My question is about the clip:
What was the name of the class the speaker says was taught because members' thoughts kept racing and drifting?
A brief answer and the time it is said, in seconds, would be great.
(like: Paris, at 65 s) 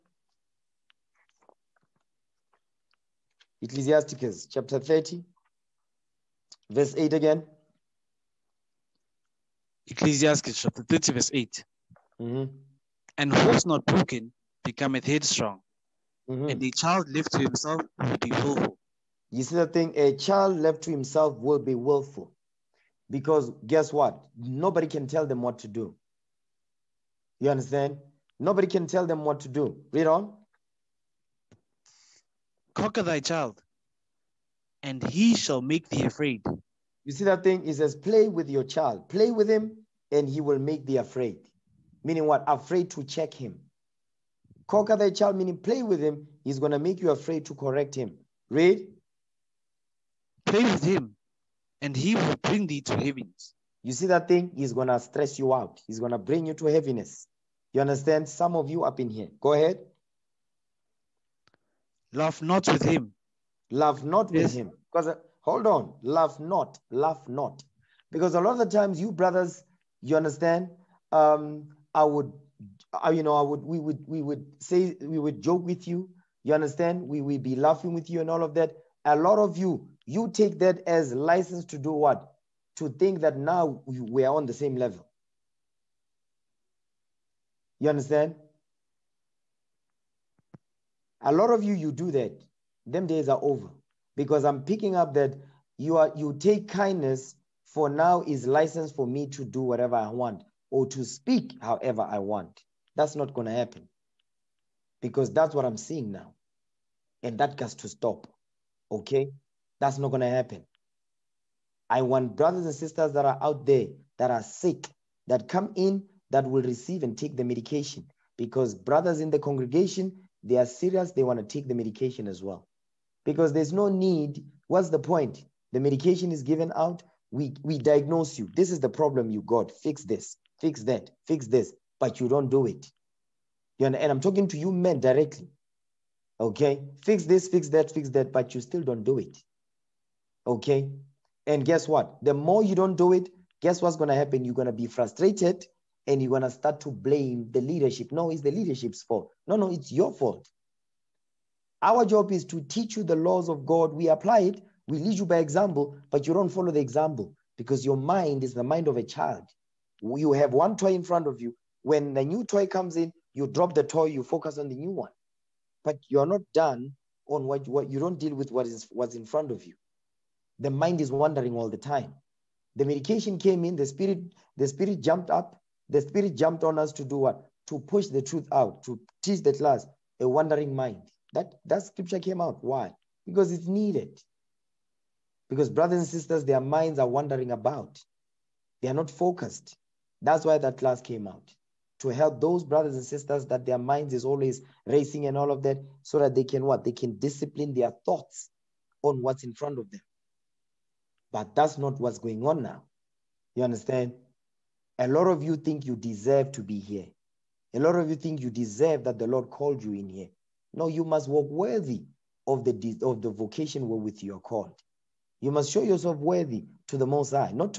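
A Wandering Mind, at 180 s.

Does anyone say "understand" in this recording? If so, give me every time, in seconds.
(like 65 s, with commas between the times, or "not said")
27 s, 57 s, 70 s, 76 s, 87 s, 203 s.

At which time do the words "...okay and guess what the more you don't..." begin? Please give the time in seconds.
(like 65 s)
140 s.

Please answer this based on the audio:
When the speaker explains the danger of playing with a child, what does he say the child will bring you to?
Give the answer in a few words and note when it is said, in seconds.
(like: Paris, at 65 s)
heaviness, at 56 s.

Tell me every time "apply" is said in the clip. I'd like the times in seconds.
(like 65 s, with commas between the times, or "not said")
154 s.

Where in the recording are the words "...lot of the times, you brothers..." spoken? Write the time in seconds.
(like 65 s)
68 s.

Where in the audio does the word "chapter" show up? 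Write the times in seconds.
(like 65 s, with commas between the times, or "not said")
4 s, 10 s.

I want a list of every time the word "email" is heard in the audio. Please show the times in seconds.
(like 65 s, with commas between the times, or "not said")
not said.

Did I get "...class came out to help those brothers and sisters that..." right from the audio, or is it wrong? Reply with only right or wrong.
right.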